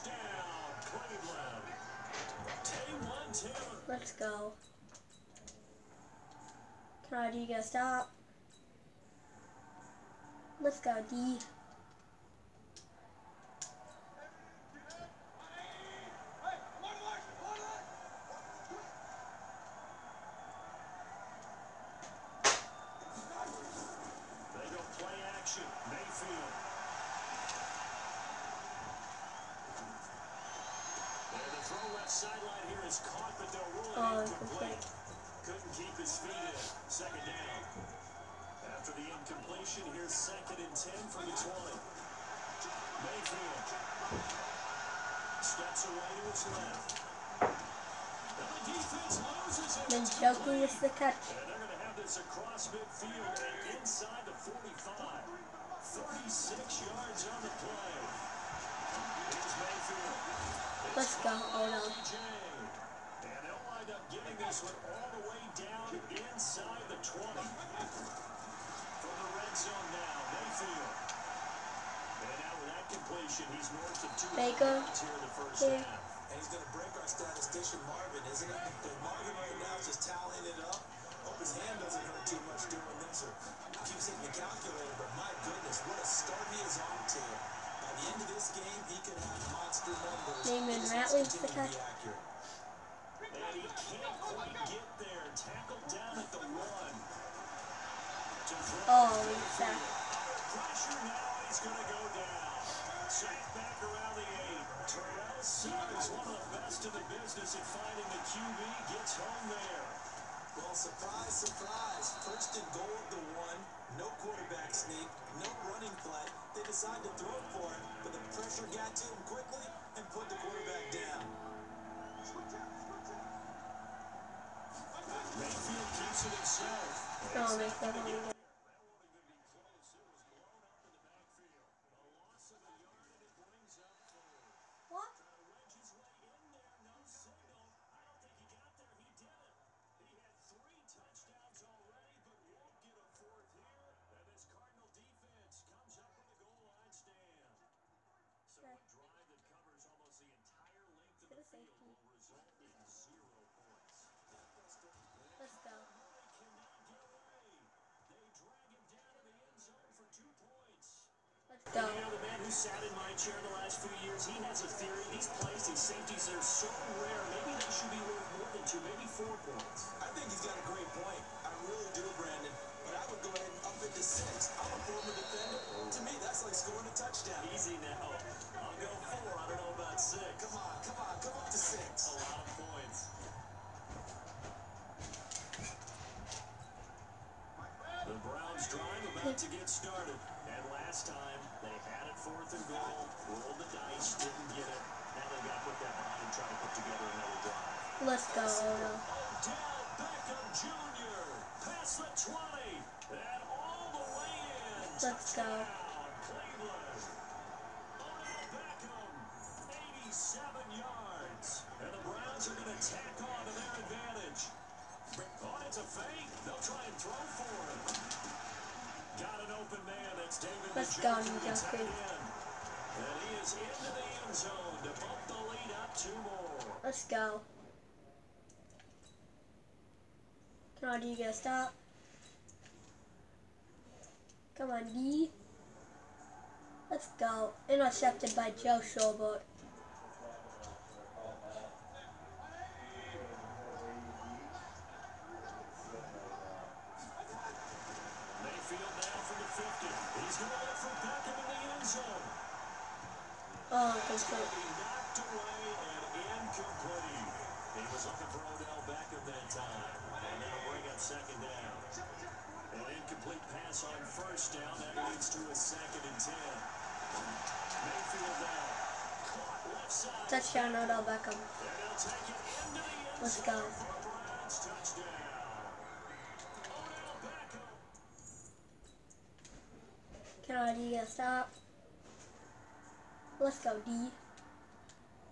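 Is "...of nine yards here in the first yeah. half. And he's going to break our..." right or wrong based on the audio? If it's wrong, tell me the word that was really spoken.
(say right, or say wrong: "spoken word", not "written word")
wrong: "two", not "nine".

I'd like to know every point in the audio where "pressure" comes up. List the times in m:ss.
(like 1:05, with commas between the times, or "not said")
1:40, 1:58.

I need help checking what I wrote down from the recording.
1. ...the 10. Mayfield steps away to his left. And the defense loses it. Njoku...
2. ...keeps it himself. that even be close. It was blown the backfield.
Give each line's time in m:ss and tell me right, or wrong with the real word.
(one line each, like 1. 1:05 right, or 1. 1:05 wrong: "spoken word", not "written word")
1. 0:41 wrong: "20", not "10"
2. 2:05 right.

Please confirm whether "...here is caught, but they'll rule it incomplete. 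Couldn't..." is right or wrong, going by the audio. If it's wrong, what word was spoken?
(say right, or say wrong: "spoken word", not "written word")
right.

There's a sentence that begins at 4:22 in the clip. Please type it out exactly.
An incomplete pass on first down.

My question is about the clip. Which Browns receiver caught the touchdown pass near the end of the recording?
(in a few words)
Odell Beckham.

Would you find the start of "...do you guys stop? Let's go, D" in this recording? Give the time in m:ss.
0:07.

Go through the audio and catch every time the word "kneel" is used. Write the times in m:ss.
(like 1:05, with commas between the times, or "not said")
not said.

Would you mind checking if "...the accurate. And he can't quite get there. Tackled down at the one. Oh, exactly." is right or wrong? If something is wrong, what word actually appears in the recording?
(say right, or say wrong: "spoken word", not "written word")
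right.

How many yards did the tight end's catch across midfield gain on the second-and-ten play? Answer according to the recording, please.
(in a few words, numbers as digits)
36.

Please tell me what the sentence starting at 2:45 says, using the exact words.
These plays, these safeties, they're so rare.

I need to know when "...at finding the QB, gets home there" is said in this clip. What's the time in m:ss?
1:47.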